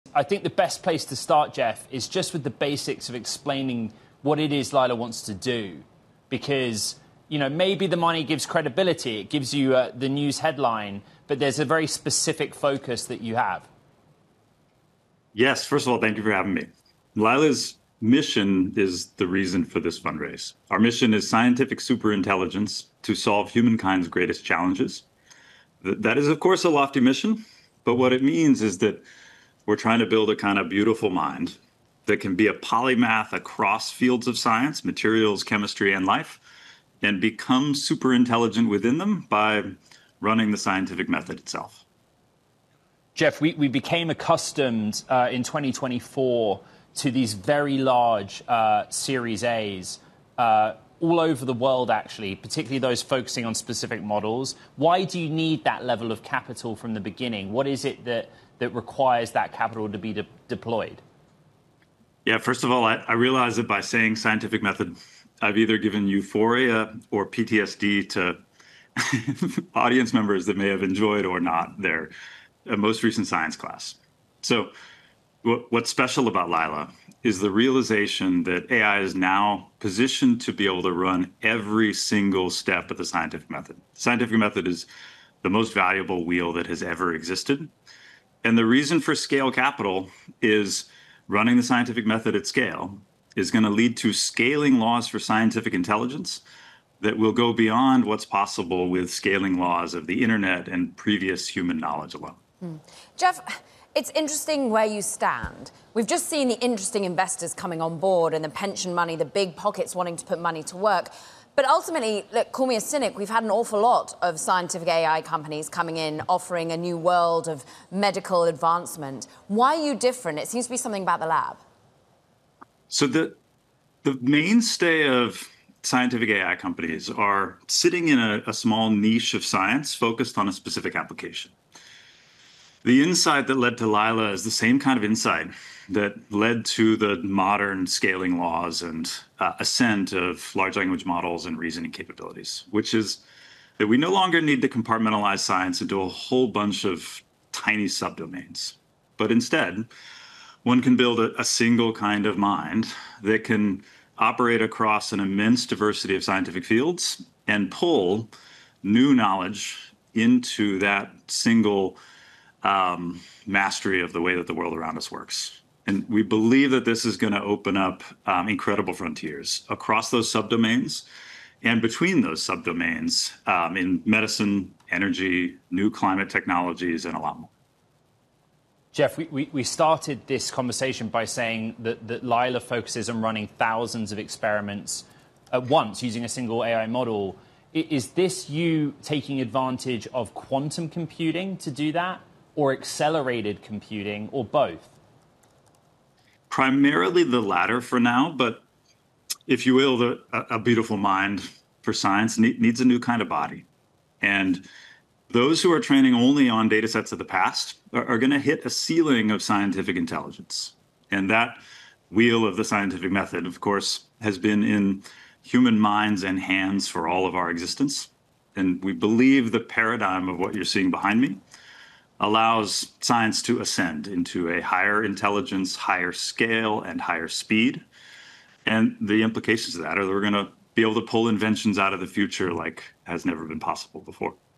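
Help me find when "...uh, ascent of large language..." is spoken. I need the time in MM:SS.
02:19.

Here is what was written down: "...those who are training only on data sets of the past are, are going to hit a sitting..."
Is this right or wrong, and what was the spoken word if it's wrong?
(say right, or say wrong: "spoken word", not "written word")
wrong: "ceiling", not "sitting".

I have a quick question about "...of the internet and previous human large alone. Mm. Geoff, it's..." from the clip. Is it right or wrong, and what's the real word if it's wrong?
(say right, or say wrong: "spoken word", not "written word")
wrong: "knowledge", not "large".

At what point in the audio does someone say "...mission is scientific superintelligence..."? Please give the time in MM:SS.
00:20.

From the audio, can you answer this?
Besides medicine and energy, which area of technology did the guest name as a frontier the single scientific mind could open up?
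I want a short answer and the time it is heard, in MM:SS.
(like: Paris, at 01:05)
Climate technologies, at 02:55.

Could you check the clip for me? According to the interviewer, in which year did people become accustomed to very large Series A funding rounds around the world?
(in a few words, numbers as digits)
2024.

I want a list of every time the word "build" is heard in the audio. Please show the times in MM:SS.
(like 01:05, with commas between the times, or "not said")
00:30, 02:30.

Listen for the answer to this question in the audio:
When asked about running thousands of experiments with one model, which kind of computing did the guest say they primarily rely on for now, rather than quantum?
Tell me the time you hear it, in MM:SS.
03:12.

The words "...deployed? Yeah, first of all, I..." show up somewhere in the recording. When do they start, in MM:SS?
01:00.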